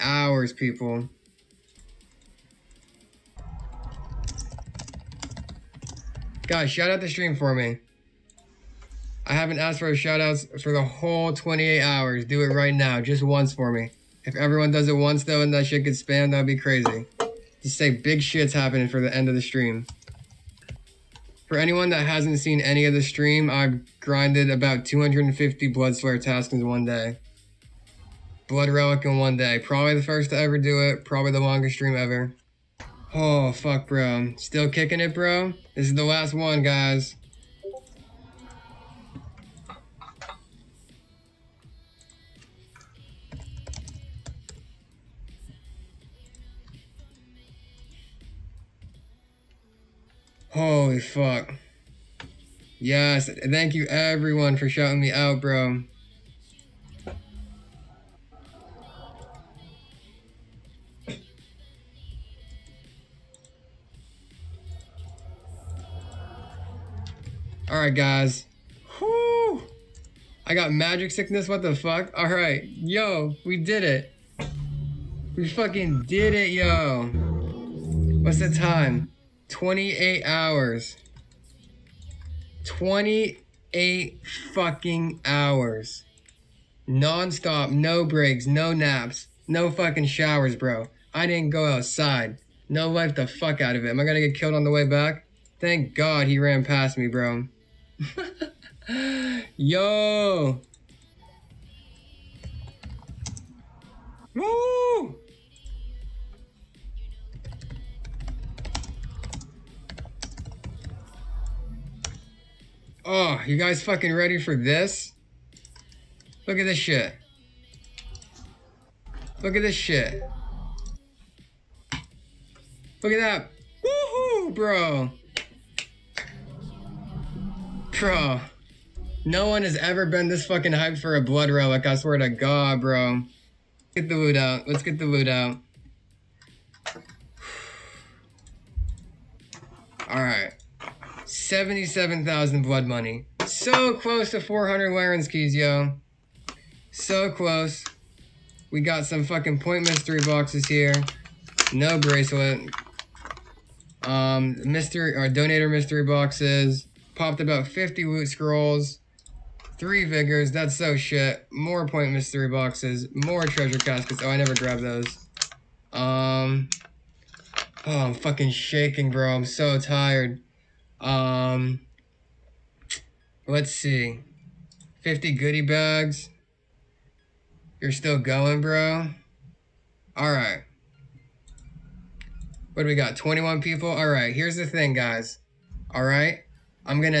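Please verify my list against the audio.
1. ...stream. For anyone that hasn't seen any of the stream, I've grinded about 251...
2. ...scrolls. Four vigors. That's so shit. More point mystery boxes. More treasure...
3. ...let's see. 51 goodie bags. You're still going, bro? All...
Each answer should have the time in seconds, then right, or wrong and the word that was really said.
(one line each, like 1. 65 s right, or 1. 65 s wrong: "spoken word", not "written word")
1. 19 s wrong: "250", not "251"
2. 158 s wrong: "Three", not "Four"
3. 173 s wrong: "50", not "51".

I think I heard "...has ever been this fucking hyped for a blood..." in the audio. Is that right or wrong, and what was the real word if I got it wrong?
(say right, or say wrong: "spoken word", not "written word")
right.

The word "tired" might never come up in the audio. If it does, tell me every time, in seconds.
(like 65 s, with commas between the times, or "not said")
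169 s.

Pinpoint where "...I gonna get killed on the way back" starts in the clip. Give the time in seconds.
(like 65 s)
93 s.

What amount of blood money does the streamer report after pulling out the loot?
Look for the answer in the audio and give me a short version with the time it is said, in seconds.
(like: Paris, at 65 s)
77,000, at 141 s.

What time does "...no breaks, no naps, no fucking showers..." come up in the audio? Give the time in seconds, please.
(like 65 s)
87 s.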